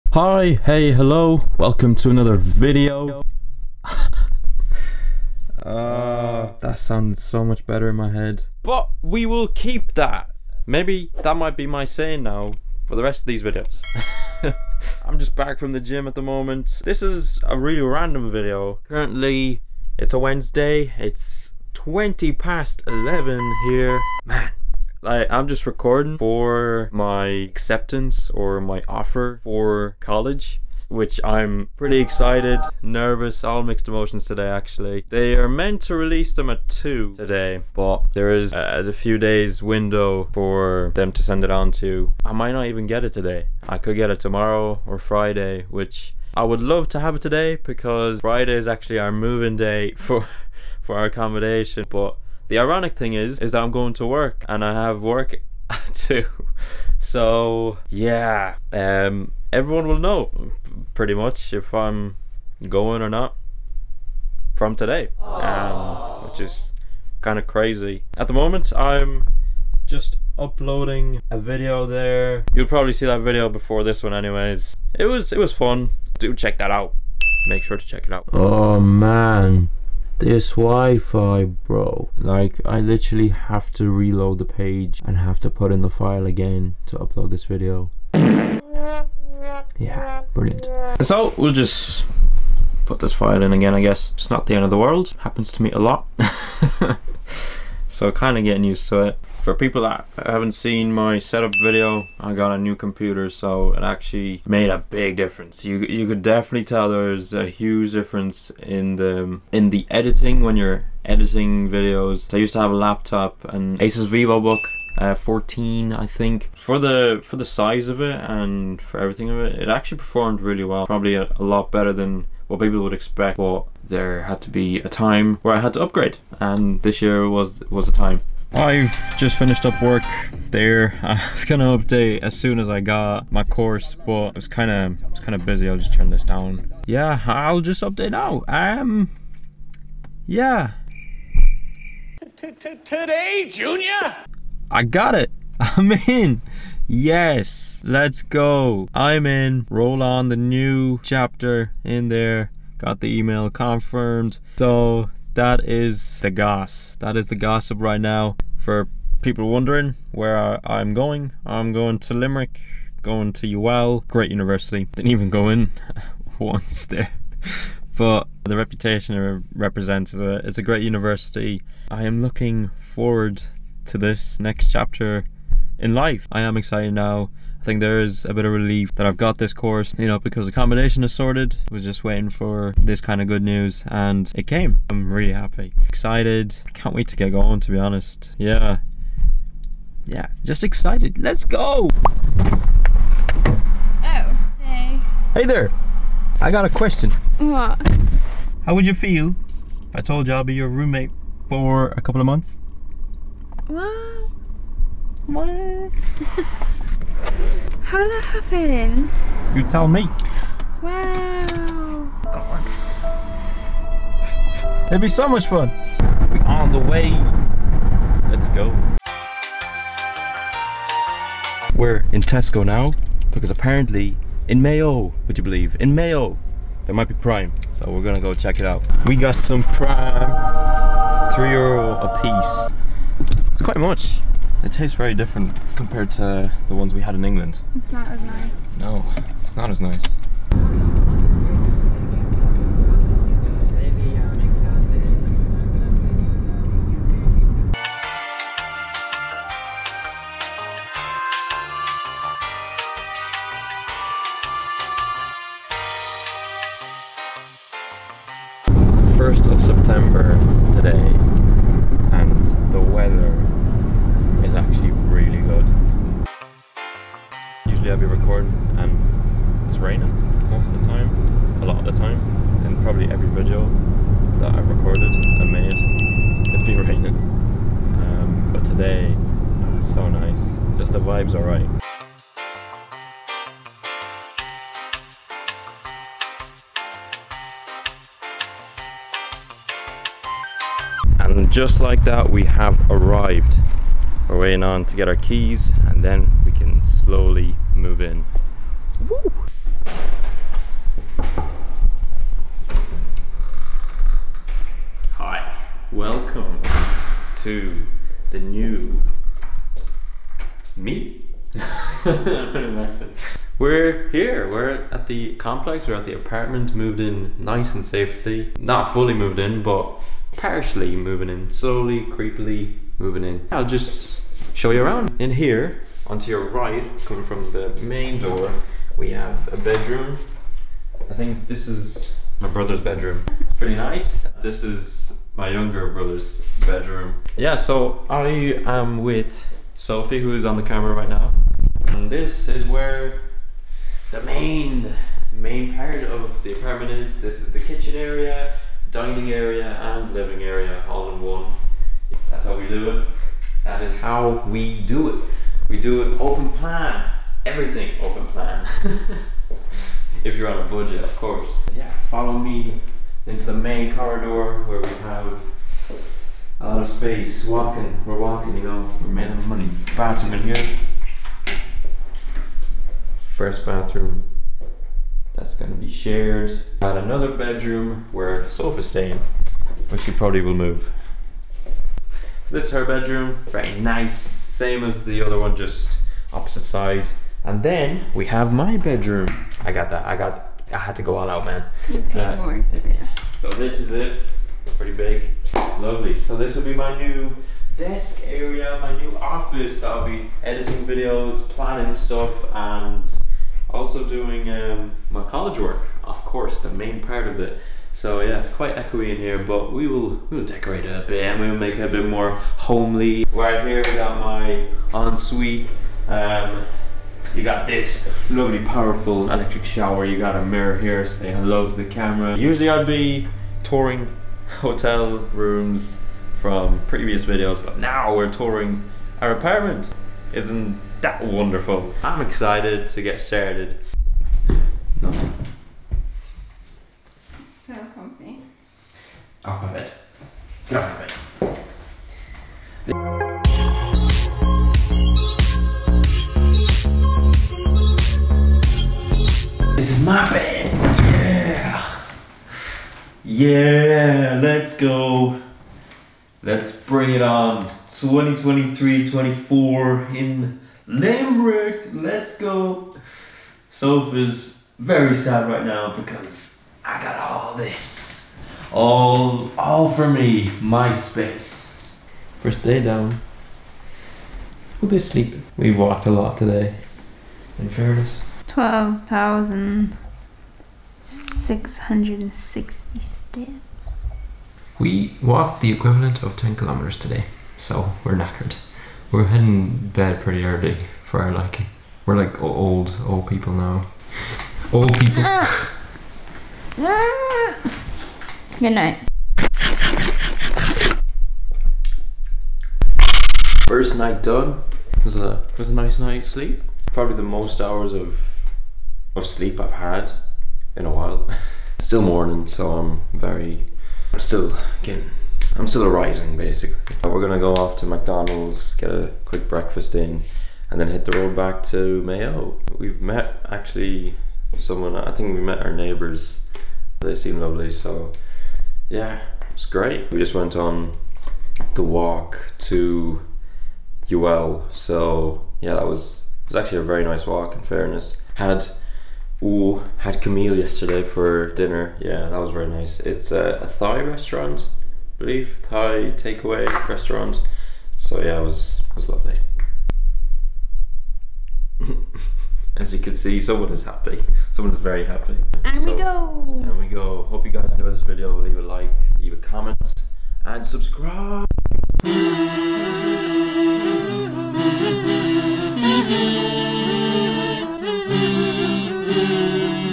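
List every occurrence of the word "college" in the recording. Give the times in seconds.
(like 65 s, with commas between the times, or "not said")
29 s, 405 s.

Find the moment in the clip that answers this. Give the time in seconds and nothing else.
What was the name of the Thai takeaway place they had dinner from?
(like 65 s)
540 s.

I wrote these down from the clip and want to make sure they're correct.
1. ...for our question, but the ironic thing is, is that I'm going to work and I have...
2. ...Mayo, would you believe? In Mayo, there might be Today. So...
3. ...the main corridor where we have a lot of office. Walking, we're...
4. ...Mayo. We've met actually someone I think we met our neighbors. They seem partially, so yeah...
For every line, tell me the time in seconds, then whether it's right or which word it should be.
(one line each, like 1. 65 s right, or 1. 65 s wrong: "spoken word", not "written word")
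1. 50 s wrong: "accommodation", not "question"
2. 224 s wrong: "Prime", not "Today"
3. 363 s wrong: "space", not "office"
4. 522 s wrong: "lovely", not "partially".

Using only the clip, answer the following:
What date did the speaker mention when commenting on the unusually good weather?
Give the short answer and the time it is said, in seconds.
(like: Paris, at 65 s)
1 September, at 259 s.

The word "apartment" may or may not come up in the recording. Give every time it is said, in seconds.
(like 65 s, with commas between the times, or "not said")
316 s, 346 s, 429 s.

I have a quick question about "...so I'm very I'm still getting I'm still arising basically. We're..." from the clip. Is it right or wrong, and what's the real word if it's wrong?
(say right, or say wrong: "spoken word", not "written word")
right.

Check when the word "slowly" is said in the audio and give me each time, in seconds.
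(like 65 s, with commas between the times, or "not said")
296 s, 321 s.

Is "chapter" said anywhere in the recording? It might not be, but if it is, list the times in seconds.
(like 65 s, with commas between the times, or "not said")
151 s, 174 s.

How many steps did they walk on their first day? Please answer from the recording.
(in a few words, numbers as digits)
12,660.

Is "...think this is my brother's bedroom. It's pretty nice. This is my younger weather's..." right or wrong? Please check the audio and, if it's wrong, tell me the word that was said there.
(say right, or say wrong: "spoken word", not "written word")
wrong: "brother", not "weather".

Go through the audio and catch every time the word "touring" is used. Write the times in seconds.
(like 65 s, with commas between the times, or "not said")
423 s, 428 s.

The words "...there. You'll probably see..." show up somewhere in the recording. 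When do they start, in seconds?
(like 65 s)
71 s.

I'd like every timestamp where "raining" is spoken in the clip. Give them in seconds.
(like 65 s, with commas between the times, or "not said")
269 s, 276 s.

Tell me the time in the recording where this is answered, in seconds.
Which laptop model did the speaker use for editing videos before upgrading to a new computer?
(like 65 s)
113 s.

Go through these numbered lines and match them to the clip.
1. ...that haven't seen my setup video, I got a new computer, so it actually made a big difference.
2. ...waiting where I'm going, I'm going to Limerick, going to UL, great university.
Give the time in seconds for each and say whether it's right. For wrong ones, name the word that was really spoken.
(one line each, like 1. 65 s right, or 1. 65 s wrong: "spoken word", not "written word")
1. 99 s right
2. 159 s wrong: "wondering", not "waiting".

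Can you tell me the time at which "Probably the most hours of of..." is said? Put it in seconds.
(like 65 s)
506 s.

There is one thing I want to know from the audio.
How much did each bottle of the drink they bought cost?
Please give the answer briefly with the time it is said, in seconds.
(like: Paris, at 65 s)
3 euro, at 231 s.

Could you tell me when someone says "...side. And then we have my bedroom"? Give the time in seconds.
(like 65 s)
386 s.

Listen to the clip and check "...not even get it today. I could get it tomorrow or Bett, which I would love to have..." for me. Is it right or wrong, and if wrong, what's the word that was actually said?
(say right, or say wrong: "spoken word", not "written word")
wrong: "Friday", not "Bett".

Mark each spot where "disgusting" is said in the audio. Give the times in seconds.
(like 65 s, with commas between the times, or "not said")
not said.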